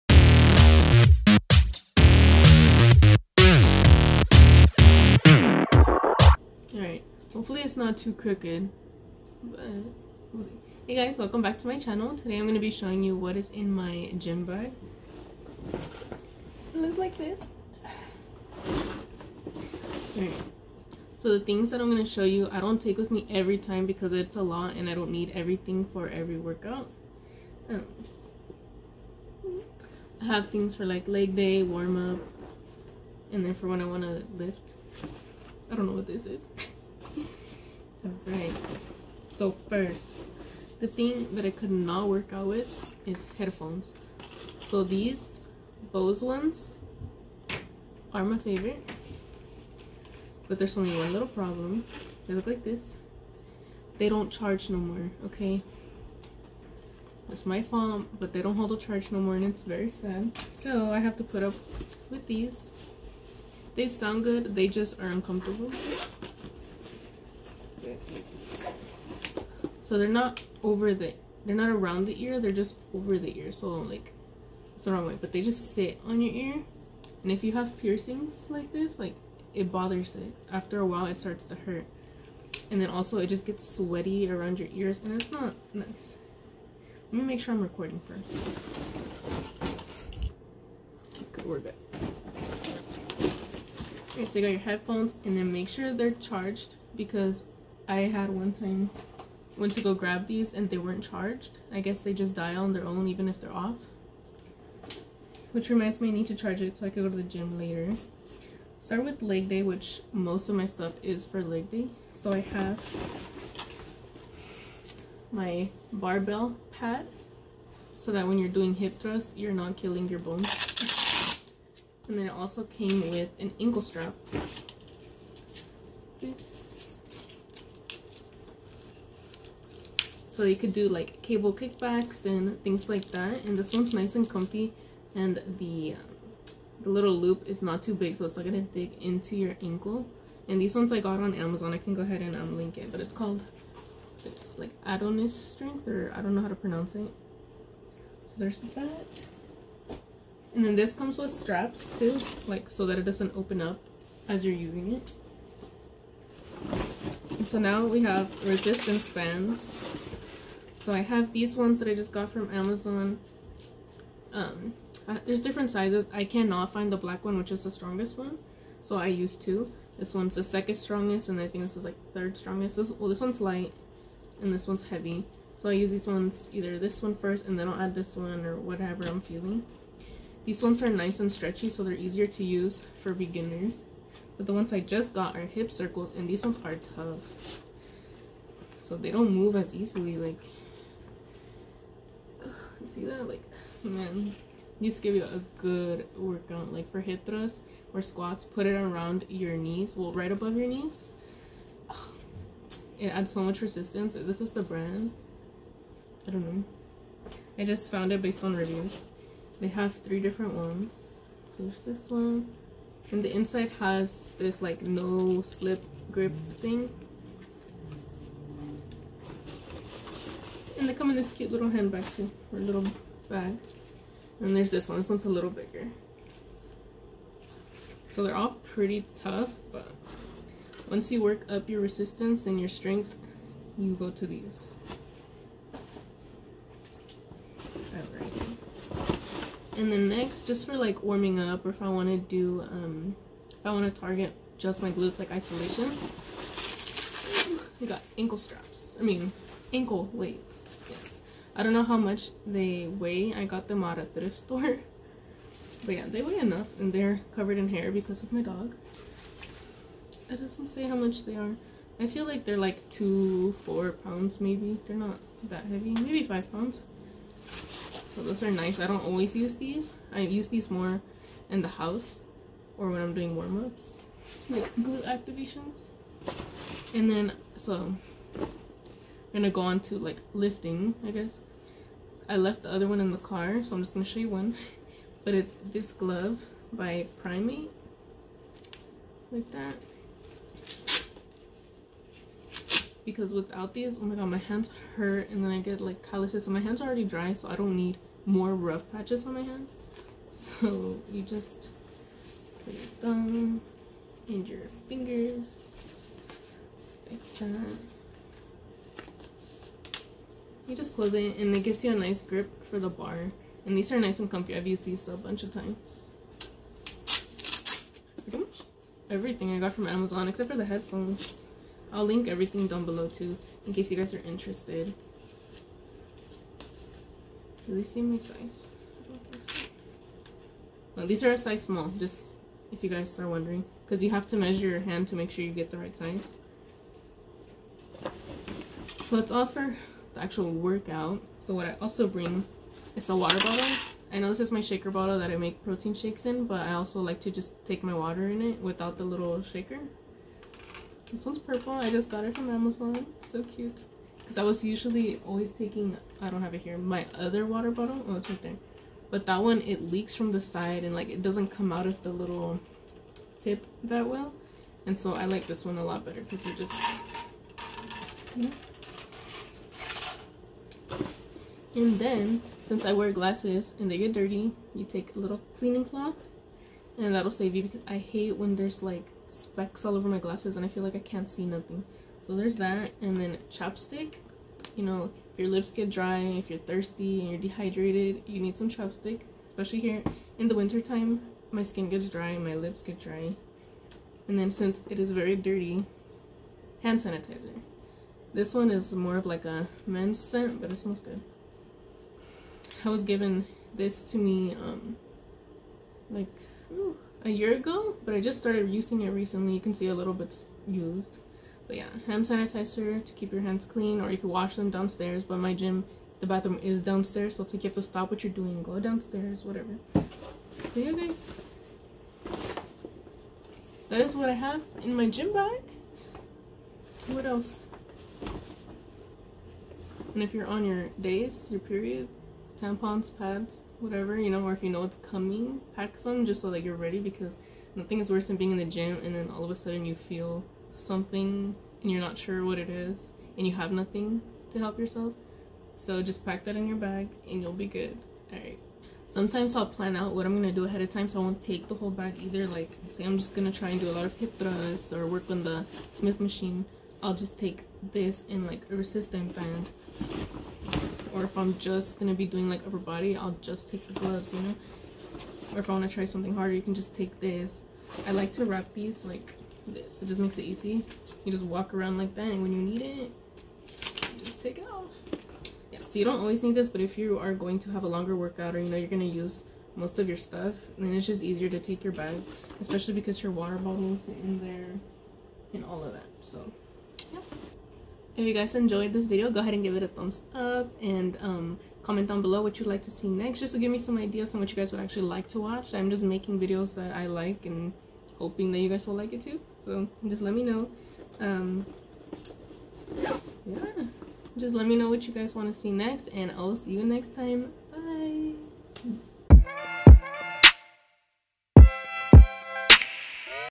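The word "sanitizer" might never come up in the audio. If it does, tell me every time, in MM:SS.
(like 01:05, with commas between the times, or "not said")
06:36, 06:52.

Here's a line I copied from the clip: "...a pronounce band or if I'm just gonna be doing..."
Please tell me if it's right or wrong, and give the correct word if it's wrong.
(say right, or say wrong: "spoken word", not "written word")
wrong: "resistance", not "pronounce".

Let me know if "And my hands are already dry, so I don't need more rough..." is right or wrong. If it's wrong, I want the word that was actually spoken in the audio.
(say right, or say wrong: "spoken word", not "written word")
right.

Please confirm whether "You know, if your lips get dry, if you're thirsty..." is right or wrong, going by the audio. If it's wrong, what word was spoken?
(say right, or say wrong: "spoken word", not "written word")
right.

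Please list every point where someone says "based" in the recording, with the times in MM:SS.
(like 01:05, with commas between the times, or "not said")
03:28.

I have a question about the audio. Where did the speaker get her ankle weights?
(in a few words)
A thrift store.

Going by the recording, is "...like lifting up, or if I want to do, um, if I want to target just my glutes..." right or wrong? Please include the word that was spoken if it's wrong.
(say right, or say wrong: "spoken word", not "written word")
wrong: "warming", not "lifting".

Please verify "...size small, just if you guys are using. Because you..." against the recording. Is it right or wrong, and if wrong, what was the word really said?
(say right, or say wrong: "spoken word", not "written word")
wrong: "wondering", not "using".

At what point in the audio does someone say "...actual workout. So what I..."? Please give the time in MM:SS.
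05:40.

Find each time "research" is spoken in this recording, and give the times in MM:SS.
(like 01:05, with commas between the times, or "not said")
not said.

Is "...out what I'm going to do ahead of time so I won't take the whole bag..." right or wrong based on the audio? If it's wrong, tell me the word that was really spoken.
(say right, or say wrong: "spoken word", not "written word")
right.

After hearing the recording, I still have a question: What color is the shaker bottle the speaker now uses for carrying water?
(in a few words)
Purple.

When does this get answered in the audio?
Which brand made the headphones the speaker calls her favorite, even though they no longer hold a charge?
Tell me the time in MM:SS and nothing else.
00:45.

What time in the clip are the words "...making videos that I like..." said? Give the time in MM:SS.
08:16.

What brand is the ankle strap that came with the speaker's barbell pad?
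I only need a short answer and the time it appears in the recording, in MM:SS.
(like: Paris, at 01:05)
Adonis Strength, at 02:24.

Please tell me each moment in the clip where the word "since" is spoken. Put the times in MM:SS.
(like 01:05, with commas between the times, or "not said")
06:12, 06:34.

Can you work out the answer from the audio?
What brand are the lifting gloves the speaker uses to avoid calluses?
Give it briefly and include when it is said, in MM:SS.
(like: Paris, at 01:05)
PRIM8, at 04:47.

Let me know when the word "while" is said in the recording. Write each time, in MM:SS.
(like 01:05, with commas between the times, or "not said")
01:20.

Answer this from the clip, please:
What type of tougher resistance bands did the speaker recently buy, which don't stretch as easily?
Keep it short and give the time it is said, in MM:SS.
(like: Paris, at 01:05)
Hip circles, at 03:05.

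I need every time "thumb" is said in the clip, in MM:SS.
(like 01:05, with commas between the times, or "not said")
05:03, 08:09.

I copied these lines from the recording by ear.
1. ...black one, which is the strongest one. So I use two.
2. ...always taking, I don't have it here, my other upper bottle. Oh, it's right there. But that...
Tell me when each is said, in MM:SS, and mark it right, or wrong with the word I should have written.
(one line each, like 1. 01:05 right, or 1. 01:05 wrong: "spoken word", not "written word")
1. 02:46 right
2. 05:55 wrong: "water", not "upper".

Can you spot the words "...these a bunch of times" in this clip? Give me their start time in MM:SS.
05:14.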